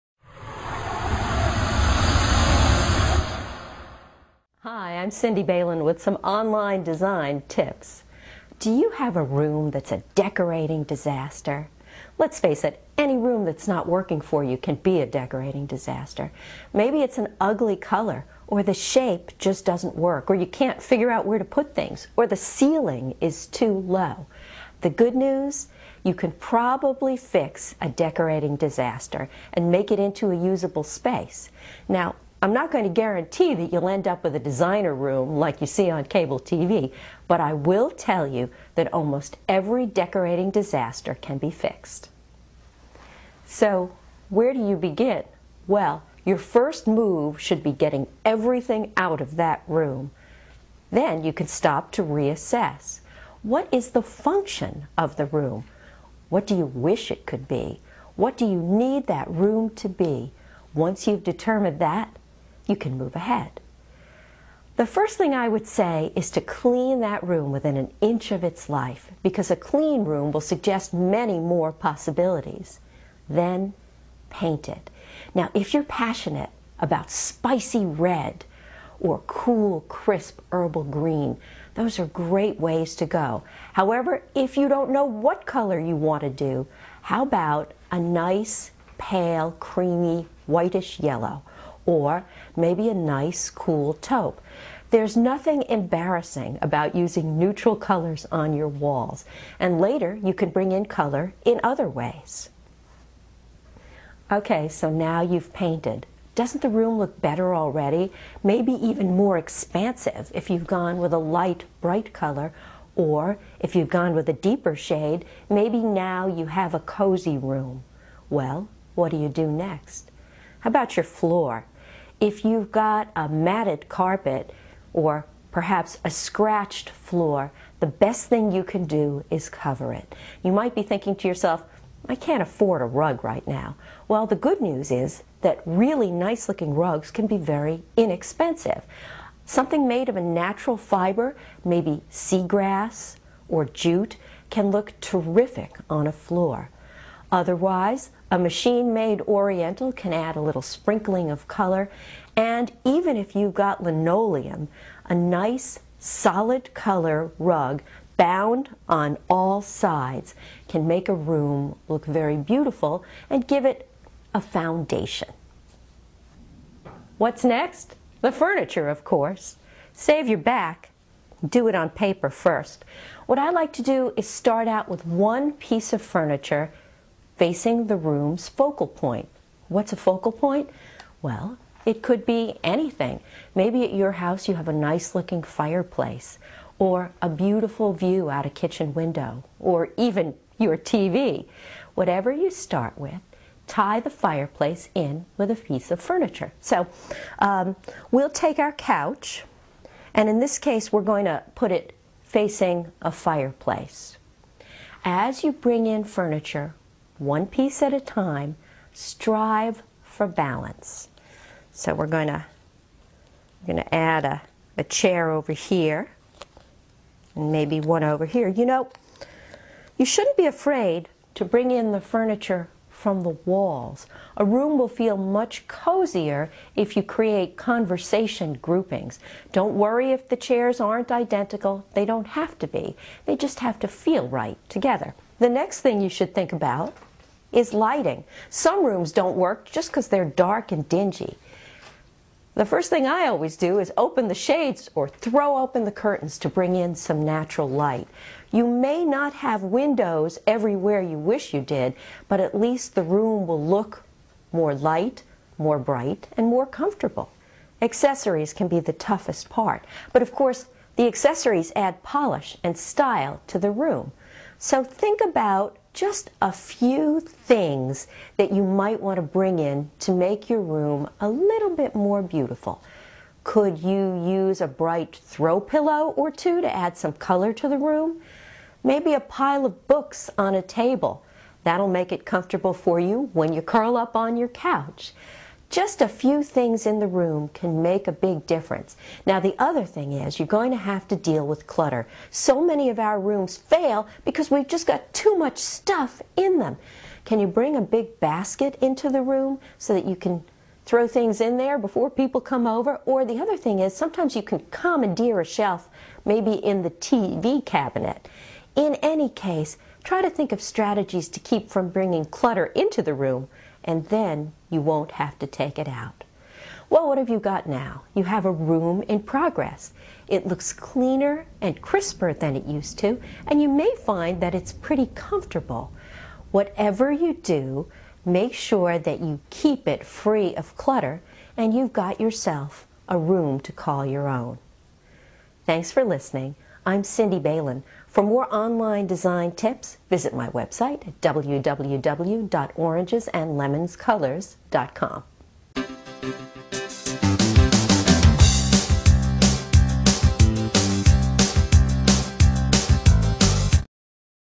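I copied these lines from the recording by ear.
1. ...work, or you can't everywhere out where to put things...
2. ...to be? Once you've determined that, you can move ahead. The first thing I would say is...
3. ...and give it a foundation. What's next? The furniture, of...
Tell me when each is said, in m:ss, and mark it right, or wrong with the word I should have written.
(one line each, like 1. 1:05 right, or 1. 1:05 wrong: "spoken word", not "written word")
1. 0:19 wrong: "figure", not "everywhere"
2. 0:59 right
3. 2:43 right.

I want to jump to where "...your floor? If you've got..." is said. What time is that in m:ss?
2:00.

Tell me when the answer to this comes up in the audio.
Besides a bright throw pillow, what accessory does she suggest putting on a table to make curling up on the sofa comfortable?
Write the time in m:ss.
4:39.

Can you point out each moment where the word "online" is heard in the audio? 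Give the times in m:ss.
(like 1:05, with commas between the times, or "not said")
0:06, 5:38.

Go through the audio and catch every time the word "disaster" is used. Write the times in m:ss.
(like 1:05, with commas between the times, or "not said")
0:10, 0:15, 0:28, 0:40.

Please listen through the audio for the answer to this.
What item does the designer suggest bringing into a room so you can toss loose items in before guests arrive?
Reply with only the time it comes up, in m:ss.
4:57.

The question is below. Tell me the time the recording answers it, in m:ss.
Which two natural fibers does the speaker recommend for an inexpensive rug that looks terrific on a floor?
2:22.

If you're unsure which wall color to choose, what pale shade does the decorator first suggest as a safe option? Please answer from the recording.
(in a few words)
creamy, whitish yellow.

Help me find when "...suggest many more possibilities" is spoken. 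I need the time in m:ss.
1:10.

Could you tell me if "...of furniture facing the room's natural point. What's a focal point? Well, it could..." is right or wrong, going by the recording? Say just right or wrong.
wrong.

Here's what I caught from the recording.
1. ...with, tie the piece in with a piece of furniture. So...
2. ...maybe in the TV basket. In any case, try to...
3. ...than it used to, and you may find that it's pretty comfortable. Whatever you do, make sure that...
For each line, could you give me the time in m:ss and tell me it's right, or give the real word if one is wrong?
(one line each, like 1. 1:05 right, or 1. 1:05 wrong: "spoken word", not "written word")
1. 3:12 wrong: "fireplace", not "piece"
2. 5:06 wrong: "cabinet", not "basket"
3. 5:22 right.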